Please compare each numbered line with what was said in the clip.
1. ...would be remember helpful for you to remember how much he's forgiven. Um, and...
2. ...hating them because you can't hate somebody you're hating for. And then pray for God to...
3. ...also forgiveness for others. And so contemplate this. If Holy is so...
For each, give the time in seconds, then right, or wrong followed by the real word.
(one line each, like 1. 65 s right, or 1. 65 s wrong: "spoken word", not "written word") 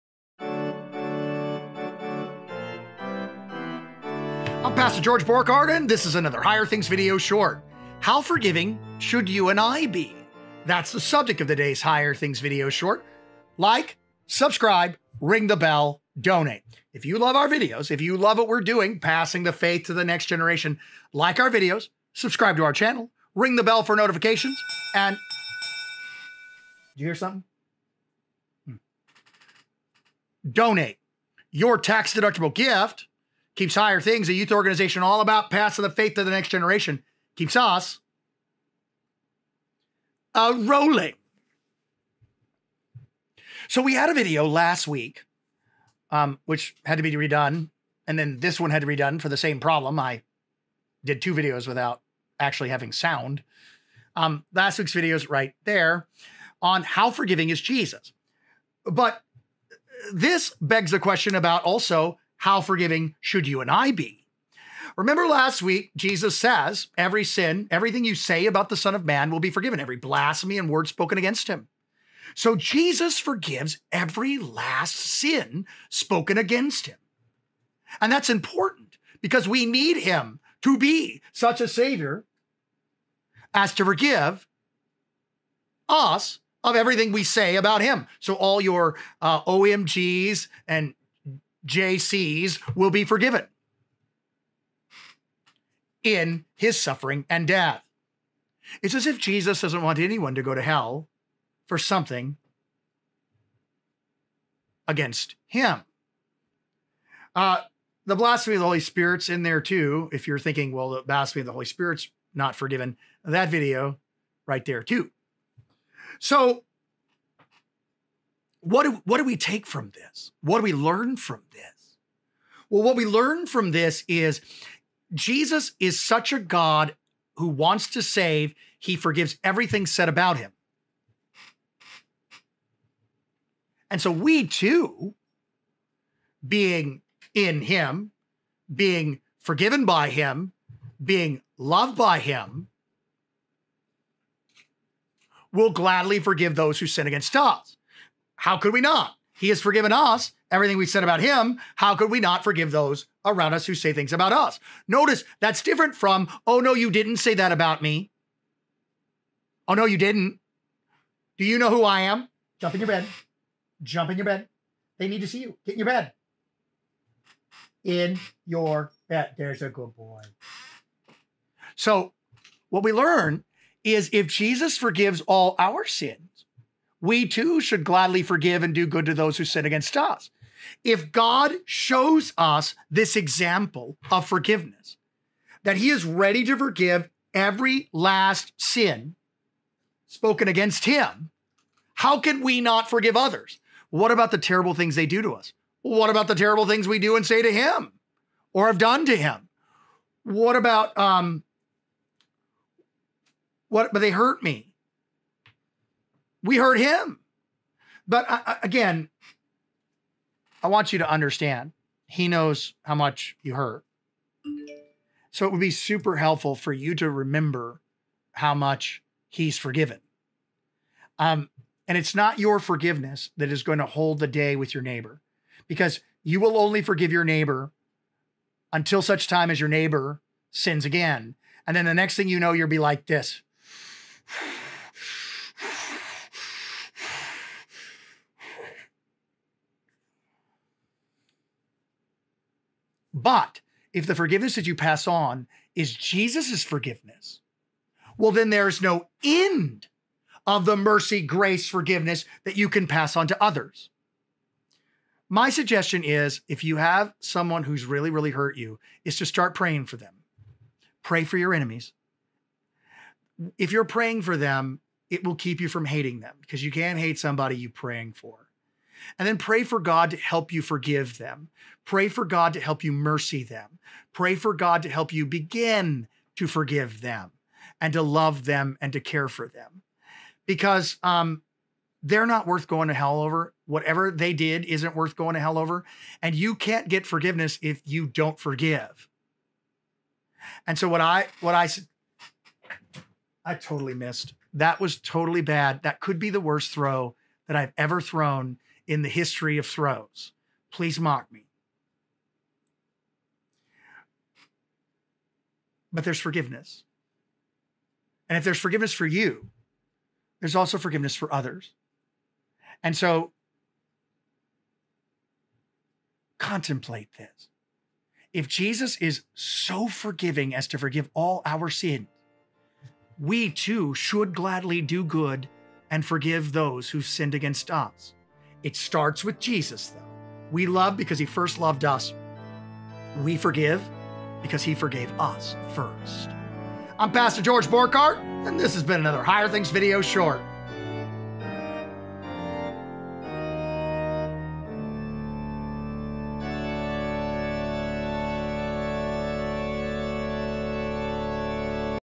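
1. 215 s wrong: "super", not "remember"
2. 265 s wrong: "praying", not "hating"
3. 310 s wrong: "Jesus", not "Holy".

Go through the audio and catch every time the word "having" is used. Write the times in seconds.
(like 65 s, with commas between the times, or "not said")
52 s.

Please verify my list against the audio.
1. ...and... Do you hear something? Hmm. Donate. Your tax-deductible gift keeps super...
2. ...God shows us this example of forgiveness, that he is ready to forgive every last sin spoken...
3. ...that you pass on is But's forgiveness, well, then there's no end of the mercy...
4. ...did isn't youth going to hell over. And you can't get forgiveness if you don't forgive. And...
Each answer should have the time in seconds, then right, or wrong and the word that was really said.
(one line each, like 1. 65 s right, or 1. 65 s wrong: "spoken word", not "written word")
1. 24 s wrong: "higher", not "super"
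2. 181 s right
3. 244 s wrong: "Jesus", not "But"
4. 284 s wrong: "worth", not "youth".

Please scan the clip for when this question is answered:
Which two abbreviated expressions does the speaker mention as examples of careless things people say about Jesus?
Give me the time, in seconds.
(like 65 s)
89 s.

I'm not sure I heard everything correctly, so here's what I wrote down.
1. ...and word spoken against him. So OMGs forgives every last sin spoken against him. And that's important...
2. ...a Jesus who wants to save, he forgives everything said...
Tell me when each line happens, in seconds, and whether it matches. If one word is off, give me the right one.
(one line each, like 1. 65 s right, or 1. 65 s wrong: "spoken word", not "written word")
1. 70 s wrong: "Jesus", not "OMGs"
2. 126 s wrong: "God", not "Jesus".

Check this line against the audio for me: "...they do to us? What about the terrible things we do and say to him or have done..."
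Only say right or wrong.
right.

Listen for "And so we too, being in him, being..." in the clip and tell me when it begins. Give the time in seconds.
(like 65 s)
133 s.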